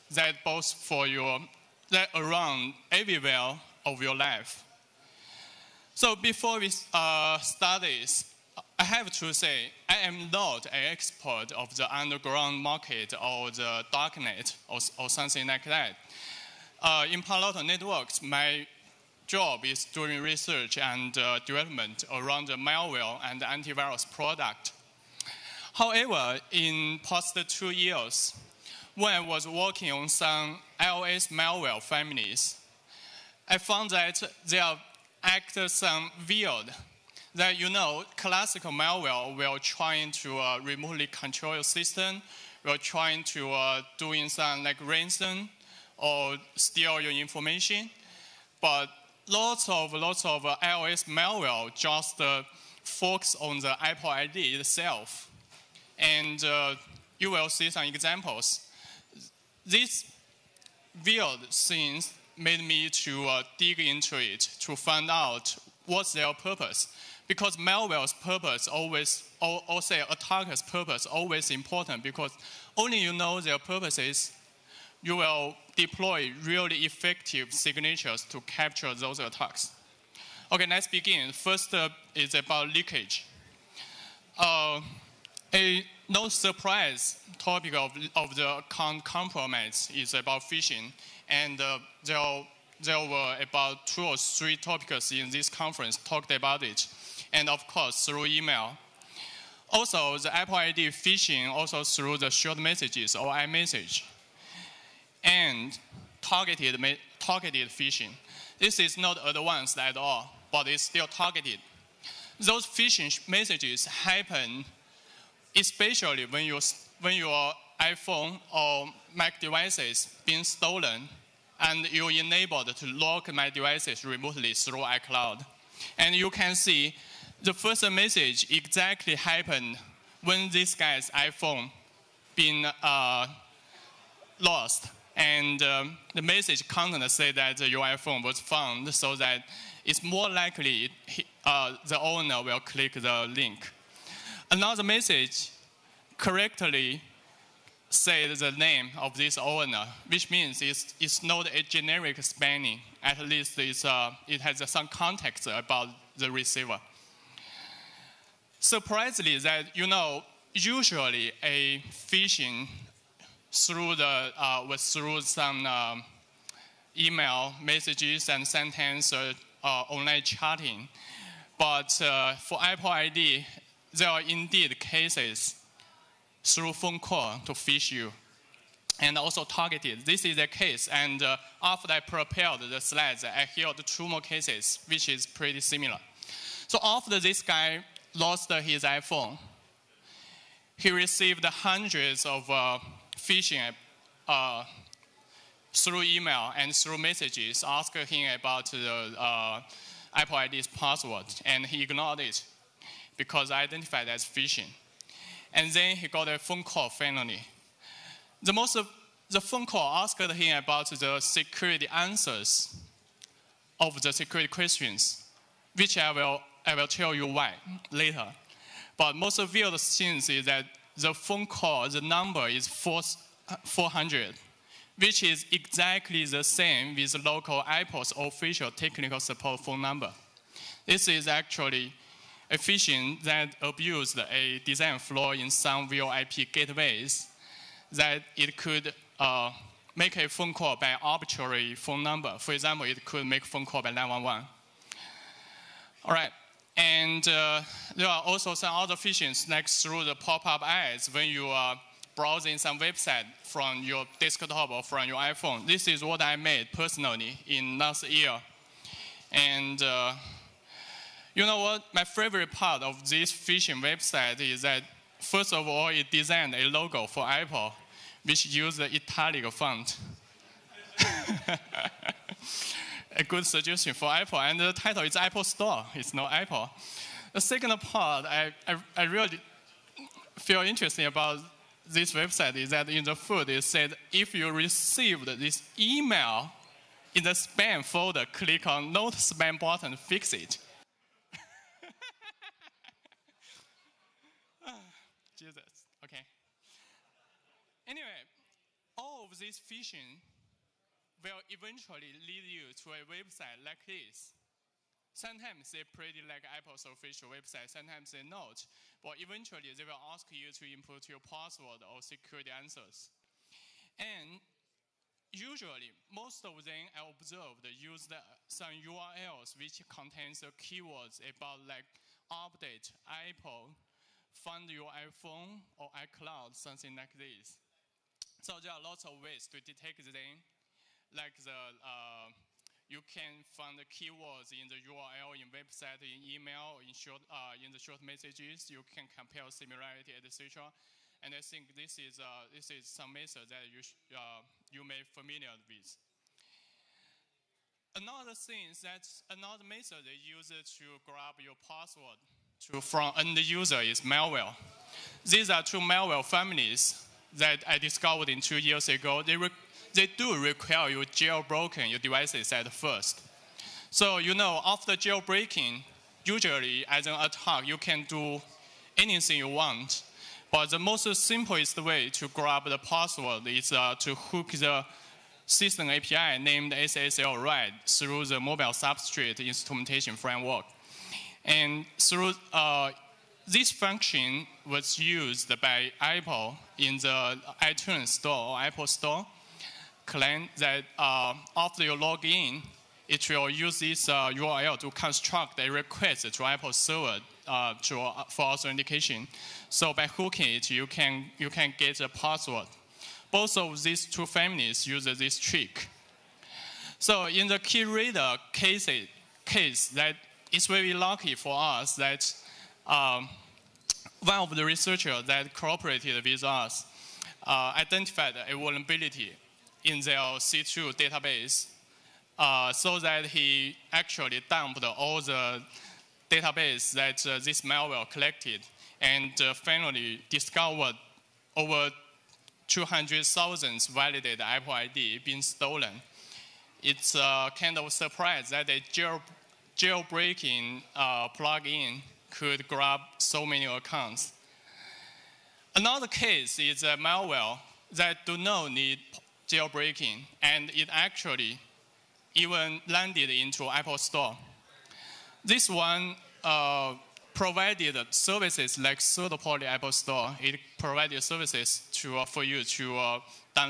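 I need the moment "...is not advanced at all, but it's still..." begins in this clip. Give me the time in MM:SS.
01:48.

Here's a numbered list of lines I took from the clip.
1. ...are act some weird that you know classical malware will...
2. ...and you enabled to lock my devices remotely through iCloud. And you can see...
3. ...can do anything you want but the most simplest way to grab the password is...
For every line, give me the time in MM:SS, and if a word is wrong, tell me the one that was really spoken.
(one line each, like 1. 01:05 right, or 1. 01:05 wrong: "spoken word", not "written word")
1. 00:34 right
2. 02:01 right
3. 06:07 right.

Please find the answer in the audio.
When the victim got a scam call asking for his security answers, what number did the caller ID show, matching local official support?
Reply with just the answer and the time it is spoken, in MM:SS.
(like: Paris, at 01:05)
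400, at 03:42.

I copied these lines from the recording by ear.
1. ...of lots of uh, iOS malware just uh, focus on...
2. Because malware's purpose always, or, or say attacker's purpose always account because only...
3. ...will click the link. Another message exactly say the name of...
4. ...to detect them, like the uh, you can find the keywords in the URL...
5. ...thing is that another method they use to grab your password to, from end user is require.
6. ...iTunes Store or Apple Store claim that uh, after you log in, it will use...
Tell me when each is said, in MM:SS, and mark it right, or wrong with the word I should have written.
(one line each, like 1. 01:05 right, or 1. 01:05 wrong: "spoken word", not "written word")
1. 00:49 right
2. 01:07 wrong: "important", not "account"
3. 02:22 wrong: "correctly", not "exactly"
4. 05:29 right
5. 05:48 wrong: "malware", not "require"
6. 06:27 right.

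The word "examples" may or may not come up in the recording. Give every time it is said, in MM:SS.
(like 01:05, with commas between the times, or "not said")
00:57, 04:02.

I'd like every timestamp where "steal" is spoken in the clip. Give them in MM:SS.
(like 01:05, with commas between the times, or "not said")
00:46.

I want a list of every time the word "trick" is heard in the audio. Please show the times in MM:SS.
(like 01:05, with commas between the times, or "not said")
06:45.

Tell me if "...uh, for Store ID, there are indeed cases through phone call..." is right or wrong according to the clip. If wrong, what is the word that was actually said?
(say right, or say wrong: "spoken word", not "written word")
wrong: "Apple", not "Store".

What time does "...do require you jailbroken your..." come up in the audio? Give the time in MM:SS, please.
06:00.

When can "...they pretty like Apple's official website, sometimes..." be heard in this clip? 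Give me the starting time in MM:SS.
05:05.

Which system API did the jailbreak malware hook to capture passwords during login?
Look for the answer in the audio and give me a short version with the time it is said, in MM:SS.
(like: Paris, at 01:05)
SSL read, at 06:16.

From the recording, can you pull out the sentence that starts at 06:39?
So by hooking it, you can, you can get a password.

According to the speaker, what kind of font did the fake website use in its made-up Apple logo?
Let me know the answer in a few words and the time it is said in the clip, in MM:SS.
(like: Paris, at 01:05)
italic, at 04:28.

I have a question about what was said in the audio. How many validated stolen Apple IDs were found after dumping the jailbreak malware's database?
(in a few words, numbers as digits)
over 200,000.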